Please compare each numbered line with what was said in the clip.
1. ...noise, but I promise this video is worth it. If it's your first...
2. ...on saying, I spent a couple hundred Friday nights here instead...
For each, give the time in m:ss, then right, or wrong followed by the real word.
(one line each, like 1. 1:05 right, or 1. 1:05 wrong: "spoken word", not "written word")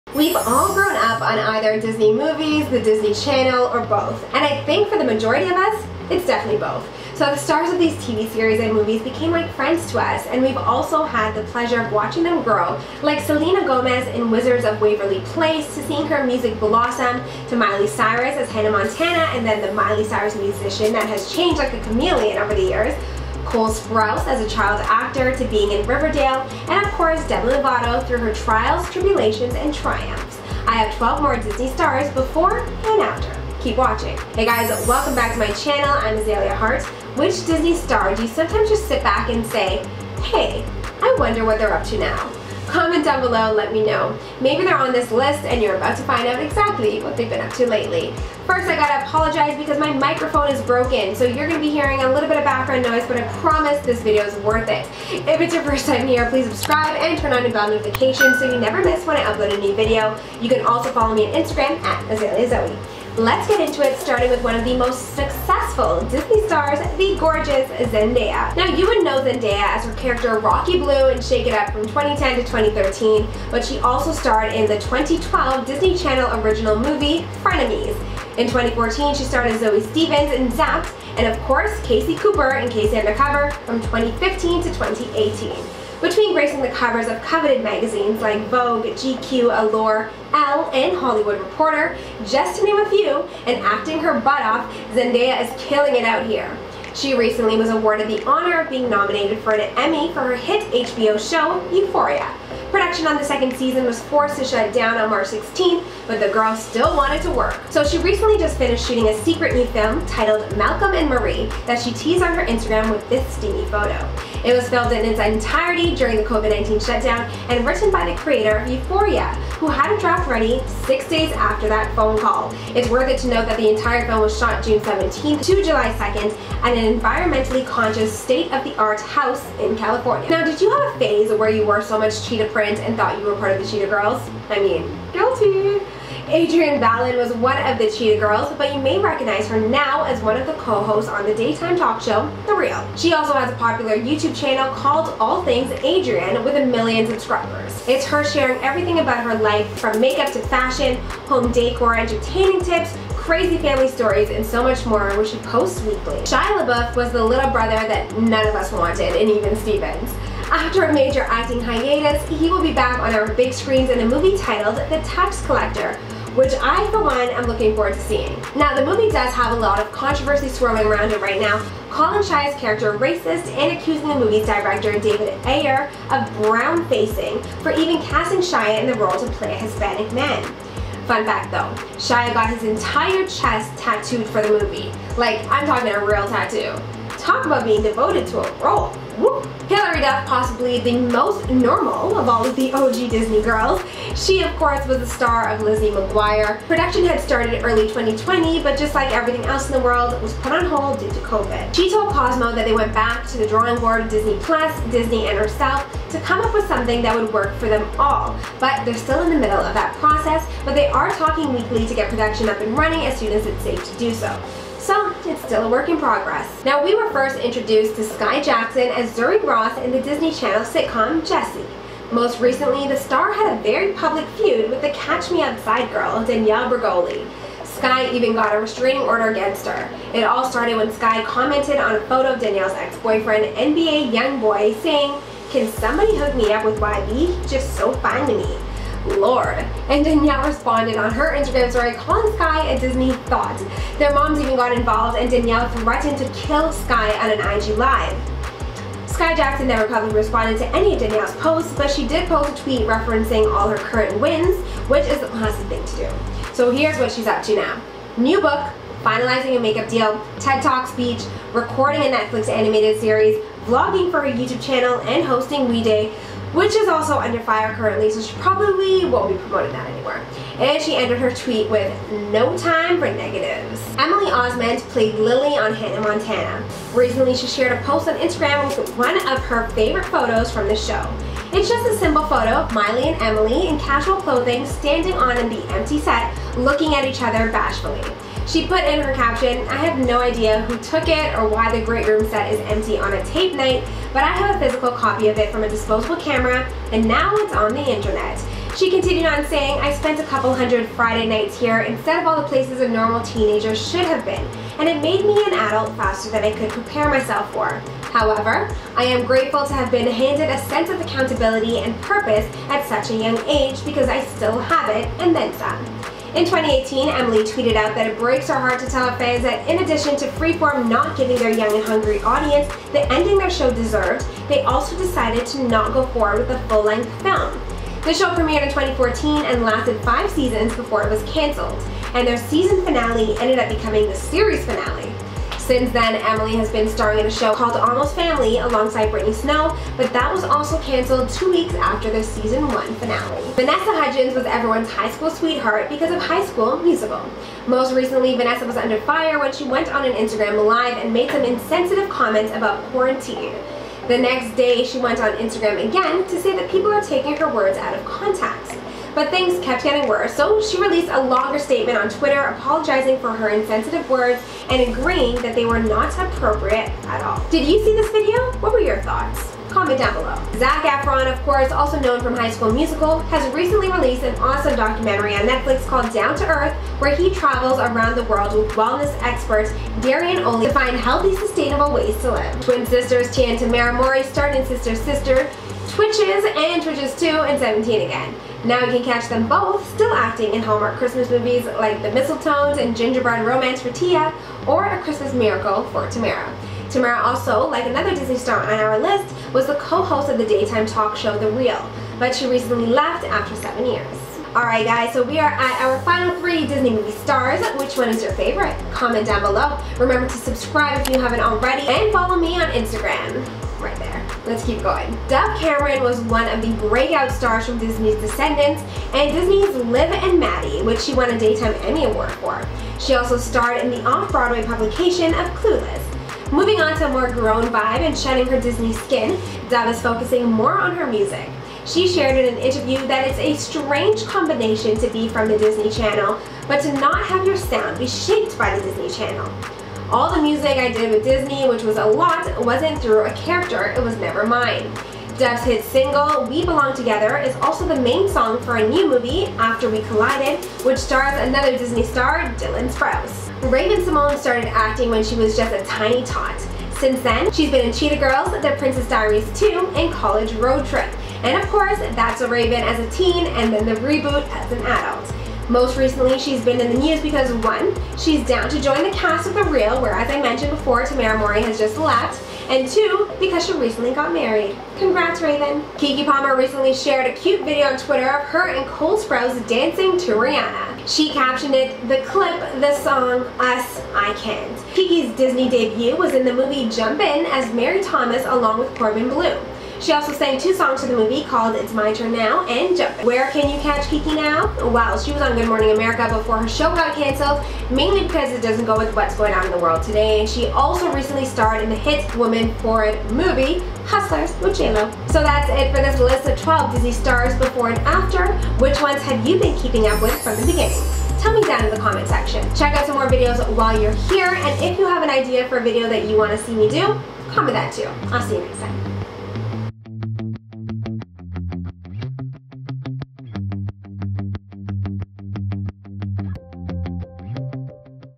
1. 0:52 right
2. 4:59 right.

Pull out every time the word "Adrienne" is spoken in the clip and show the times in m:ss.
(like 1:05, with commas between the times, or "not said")
2:16, 2:25.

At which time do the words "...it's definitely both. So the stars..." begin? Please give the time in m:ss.
0:06.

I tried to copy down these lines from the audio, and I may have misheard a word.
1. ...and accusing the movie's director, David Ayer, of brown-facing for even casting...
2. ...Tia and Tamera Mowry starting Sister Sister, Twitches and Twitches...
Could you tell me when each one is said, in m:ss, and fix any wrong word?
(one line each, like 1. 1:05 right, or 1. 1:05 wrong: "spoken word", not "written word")
1. 2:53 right
2. 6:23 right.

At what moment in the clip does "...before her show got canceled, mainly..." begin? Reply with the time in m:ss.
8:16.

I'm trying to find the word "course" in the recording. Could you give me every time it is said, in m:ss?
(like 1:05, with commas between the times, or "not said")
0:26, 1:21, 3:14, 6:11, 7:41.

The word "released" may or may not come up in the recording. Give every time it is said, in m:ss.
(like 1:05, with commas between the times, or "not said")
6:00, 6:13.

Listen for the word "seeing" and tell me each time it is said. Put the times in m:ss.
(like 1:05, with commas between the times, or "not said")
0:15, 2:48.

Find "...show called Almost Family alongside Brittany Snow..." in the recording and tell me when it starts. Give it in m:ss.
5:37.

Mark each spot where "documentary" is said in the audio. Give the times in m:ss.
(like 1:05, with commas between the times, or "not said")
6:14.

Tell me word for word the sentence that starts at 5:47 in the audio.
Most recently, Vanessa was under fire when she went on an Instagram live and made some insensitive comments about quarantine.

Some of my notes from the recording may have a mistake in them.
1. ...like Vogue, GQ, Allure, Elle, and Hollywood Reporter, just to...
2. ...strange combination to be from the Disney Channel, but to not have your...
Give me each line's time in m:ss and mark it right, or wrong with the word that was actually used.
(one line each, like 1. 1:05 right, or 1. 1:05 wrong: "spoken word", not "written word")
1. 1:28 right
2. 7:13 right.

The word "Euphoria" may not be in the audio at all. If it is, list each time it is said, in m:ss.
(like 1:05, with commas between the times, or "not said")
1:41, 1:58.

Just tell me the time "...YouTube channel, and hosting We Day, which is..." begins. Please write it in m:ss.
4:24.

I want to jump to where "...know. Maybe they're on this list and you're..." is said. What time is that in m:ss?
0:43.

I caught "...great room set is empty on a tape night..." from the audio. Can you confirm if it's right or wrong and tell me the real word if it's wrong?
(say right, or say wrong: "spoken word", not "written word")
right.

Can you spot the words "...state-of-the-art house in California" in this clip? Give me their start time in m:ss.
2:08.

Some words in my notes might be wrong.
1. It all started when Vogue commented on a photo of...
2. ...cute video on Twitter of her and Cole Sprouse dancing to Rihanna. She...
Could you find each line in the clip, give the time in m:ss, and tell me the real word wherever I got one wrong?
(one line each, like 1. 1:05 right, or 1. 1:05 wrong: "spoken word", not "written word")
1. 3:50 wrong: "Skai", not "Vogue"
2. 7:57 right.